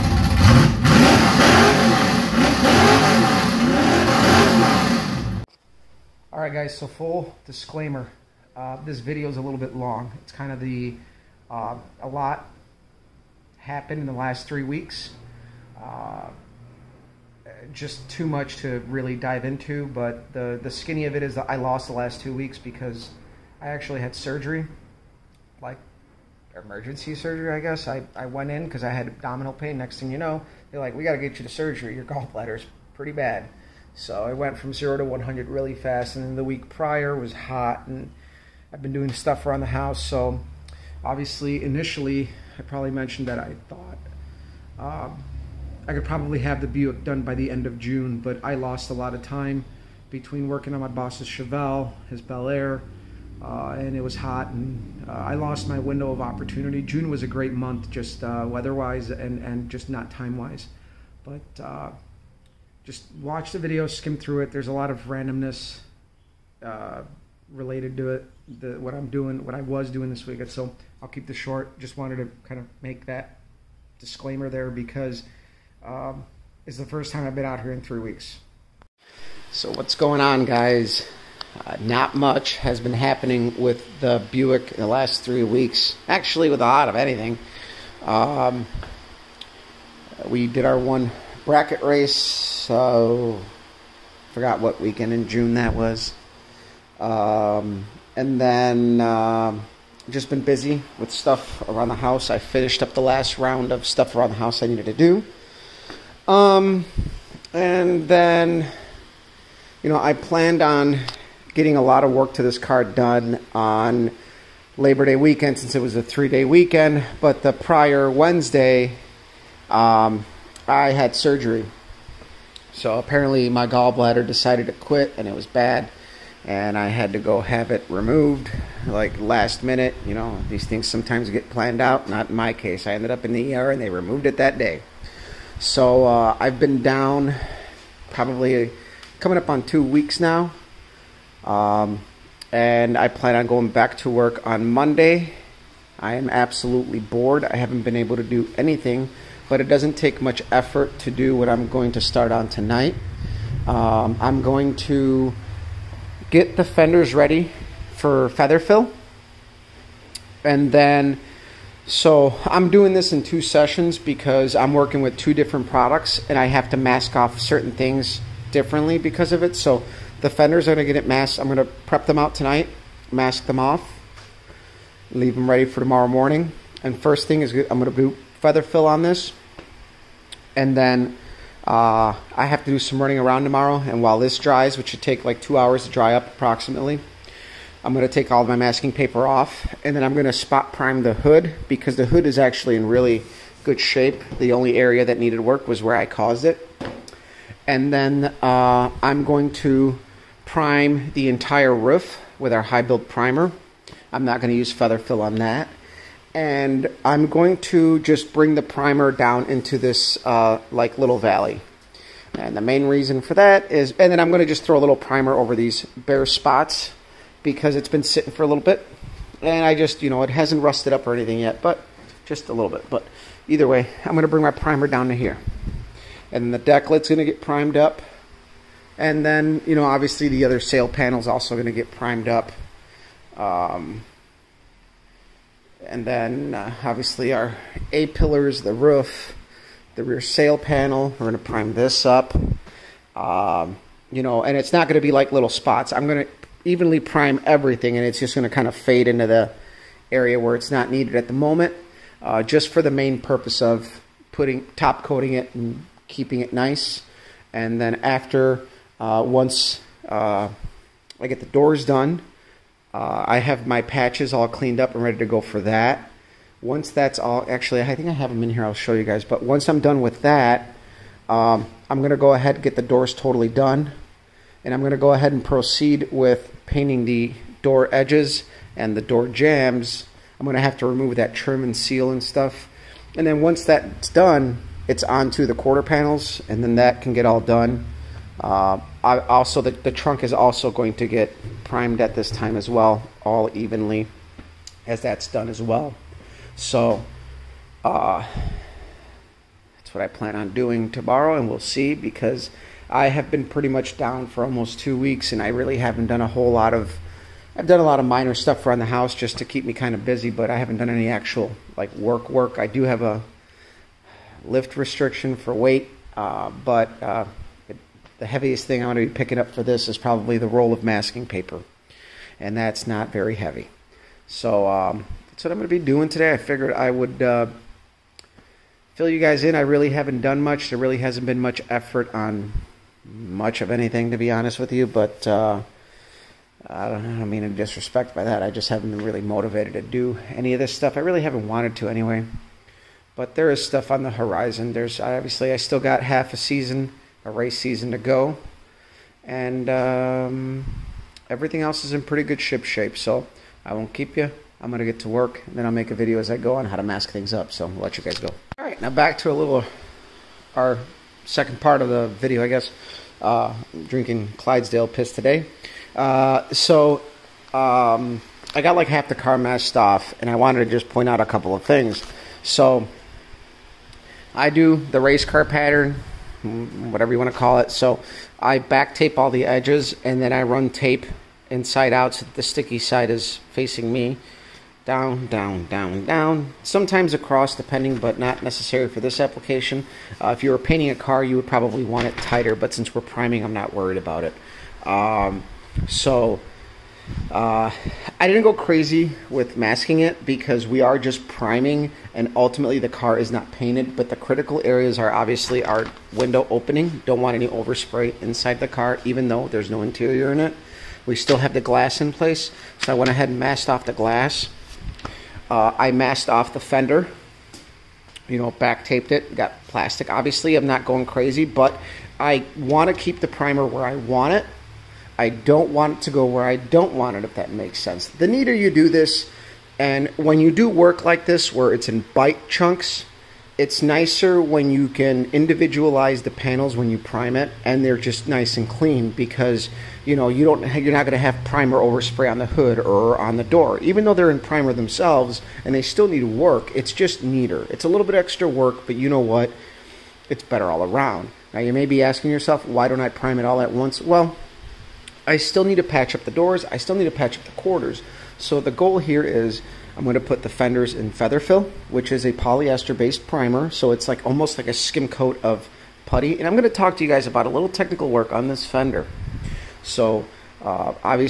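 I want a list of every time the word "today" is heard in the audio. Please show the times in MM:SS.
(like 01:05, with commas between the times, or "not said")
05:26, 06:05.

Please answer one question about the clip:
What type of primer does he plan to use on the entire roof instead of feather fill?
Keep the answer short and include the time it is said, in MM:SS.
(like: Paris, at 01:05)
high build primer, at 03:22.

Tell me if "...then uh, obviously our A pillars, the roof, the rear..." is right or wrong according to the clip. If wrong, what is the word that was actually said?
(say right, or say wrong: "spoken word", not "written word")
right.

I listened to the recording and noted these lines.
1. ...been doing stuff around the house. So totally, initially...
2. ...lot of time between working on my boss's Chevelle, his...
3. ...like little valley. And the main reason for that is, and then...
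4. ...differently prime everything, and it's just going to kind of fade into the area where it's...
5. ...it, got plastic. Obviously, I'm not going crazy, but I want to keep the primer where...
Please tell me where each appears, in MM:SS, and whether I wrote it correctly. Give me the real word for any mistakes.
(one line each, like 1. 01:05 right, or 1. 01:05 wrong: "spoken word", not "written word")
1. 00:38 wrong: "obviously", not "totally"
2. 00:48 right
3. 03:30 right
4. 04:06 wrong: "evenly", not "differently"
5. 06:59 right.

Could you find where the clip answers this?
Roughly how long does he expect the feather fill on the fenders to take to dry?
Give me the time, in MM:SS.
03:05.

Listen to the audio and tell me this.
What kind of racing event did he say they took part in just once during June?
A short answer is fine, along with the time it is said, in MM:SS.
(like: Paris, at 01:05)
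bracket race, at 01:31.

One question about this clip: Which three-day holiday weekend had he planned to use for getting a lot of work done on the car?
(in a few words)
Labor Day.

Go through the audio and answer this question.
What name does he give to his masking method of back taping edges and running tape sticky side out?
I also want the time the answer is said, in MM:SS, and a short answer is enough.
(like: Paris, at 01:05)
race car pattern, at 06:14.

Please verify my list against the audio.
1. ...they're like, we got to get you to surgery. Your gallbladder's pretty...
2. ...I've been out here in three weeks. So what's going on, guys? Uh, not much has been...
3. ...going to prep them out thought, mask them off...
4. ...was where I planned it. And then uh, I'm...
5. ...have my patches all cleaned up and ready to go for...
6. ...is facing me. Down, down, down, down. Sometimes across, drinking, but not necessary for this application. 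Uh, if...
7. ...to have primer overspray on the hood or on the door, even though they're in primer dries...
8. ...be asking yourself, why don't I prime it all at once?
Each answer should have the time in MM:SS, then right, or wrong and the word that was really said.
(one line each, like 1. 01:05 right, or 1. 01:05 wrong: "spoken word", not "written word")
1. 00:30 right
2. 01:17 right
3. 02:51 wrong: "tonight", not "thought"
4. 03:15 wrong: "caused", not "planned"
5. 04:23 right
6. 06:23 wrong: "depending", not "drinking"
7. 07:21 wrong: "themselves", not "dries"
8. 07:31 right.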